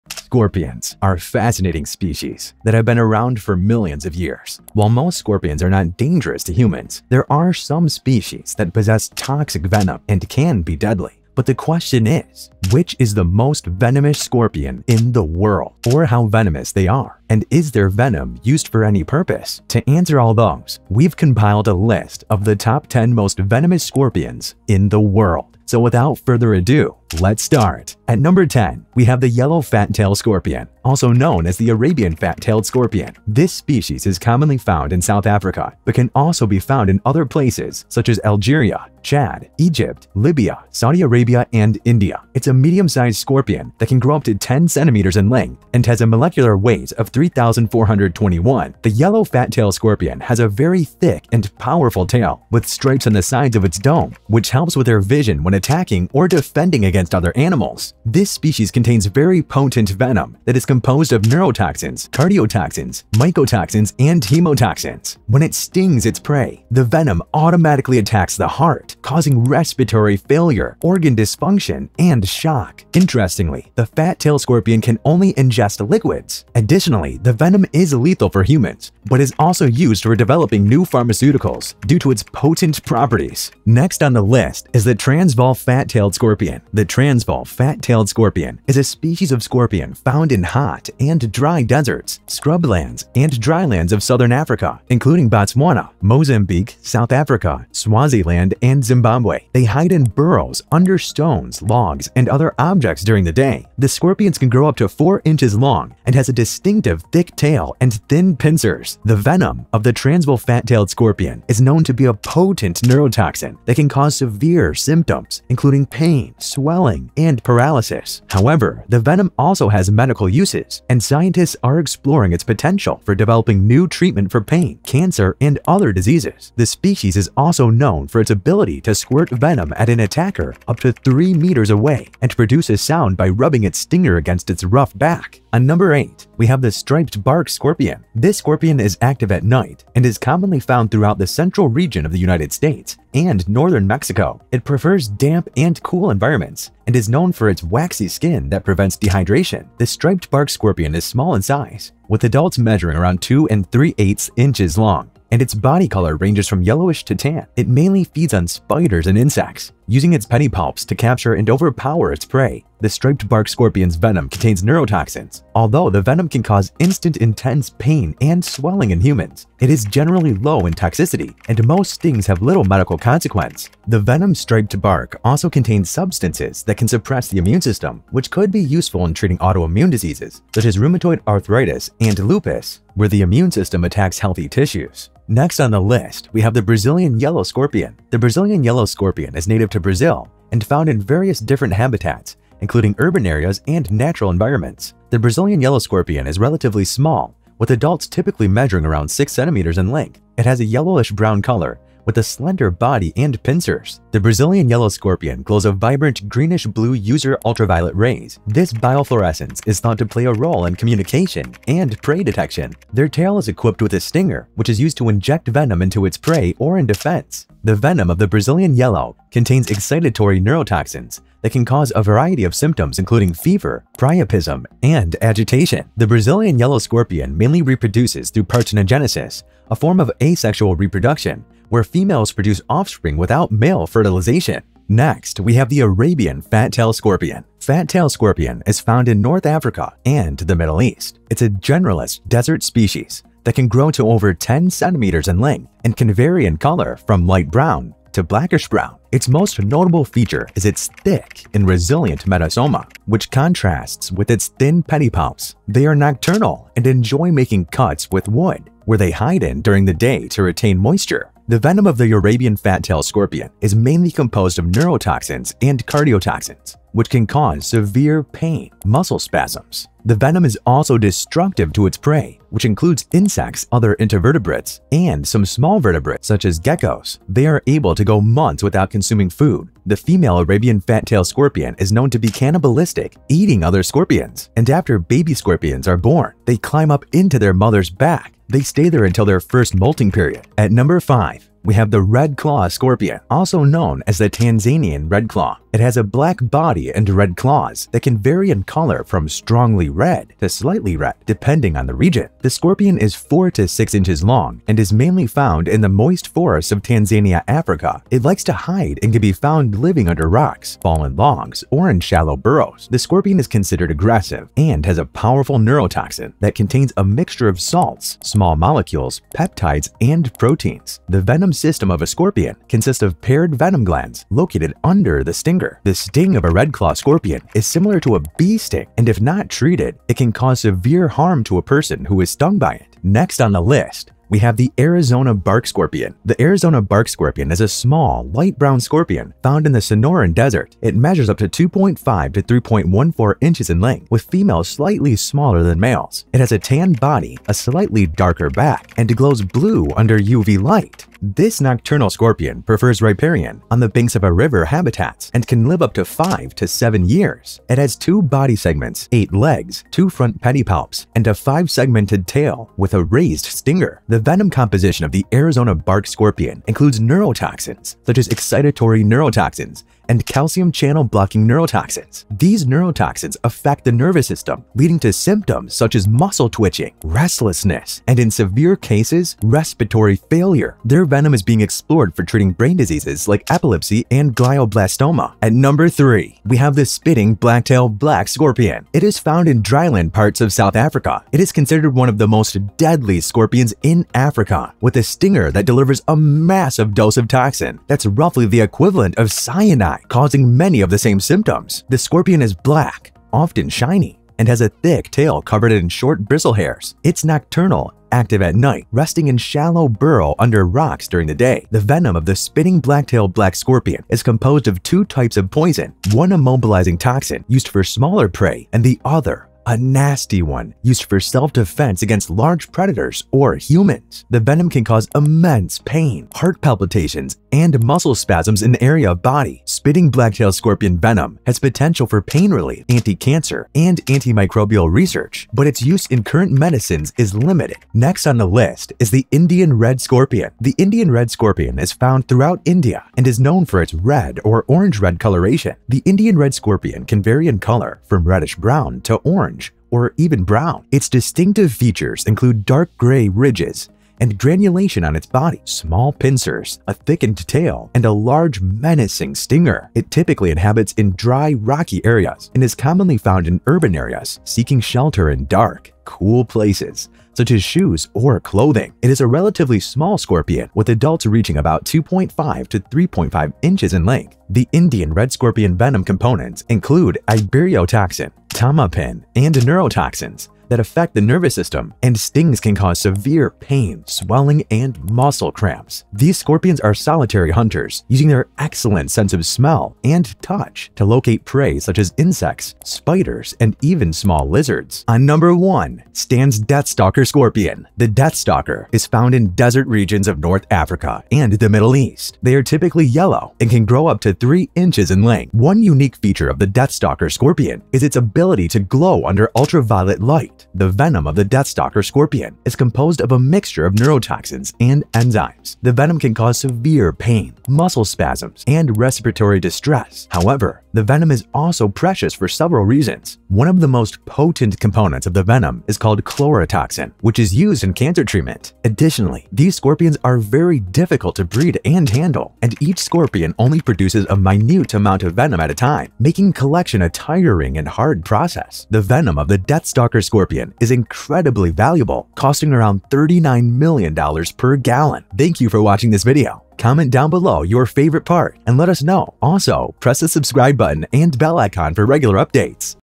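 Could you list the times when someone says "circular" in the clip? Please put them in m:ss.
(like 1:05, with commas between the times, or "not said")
not said.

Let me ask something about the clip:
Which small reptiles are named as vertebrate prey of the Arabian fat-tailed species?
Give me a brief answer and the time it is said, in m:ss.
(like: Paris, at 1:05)
Geckos, at 4:36.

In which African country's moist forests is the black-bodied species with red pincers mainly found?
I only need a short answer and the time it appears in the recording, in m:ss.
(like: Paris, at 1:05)
Tanzania, at 5:06.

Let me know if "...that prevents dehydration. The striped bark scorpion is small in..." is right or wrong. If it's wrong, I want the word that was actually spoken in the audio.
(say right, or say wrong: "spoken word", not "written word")
right.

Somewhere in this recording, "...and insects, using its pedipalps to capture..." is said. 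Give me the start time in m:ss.
2:39.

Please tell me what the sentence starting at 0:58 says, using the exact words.
This species contains very potent venom that is composed of neurotoxins, cardiotoxins, mycotoxins, and hemotoxins.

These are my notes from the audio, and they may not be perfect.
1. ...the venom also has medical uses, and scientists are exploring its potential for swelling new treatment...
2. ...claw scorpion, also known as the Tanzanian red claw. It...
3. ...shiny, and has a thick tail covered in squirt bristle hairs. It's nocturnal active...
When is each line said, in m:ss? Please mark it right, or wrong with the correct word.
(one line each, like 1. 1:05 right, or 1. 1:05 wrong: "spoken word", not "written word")
1. 1:58 wrong: "developing", not "swelling"
2. 4:52 right
3. 6:43 wrong: "short", not "squirt".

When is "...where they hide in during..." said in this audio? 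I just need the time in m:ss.
4:18.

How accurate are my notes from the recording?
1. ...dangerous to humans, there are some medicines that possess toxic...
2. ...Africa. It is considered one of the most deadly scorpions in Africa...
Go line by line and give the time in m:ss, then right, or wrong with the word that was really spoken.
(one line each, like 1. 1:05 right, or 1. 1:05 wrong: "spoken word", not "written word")
1. 0:05 wrong: "species", not "medicines"
2. 6:30 right.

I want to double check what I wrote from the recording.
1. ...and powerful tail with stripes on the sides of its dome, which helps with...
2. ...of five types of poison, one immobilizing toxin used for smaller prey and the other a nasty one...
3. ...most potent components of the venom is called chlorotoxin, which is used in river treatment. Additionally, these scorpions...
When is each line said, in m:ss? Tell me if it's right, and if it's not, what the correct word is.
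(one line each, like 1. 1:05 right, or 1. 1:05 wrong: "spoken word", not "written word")
1. 0:51 right
2. 6:54 wrong: "two", not "five"
3. 8:43 wrong: "cancer", not "river".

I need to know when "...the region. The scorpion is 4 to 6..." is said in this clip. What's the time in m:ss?
5:01.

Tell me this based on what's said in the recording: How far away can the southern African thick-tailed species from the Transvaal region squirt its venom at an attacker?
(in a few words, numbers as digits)
3 meters.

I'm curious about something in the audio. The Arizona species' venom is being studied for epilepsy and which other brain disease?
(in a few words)
Glioblastoma.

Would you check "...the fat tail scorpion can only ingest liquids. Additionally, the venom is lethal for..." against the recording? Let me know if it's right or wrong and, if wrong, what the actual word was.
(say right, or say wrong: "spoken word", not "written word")
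right.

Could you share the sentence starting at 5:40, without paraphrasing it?
It measures up to 2.5 to 3.14 inches in length, with females slightly smaller than males.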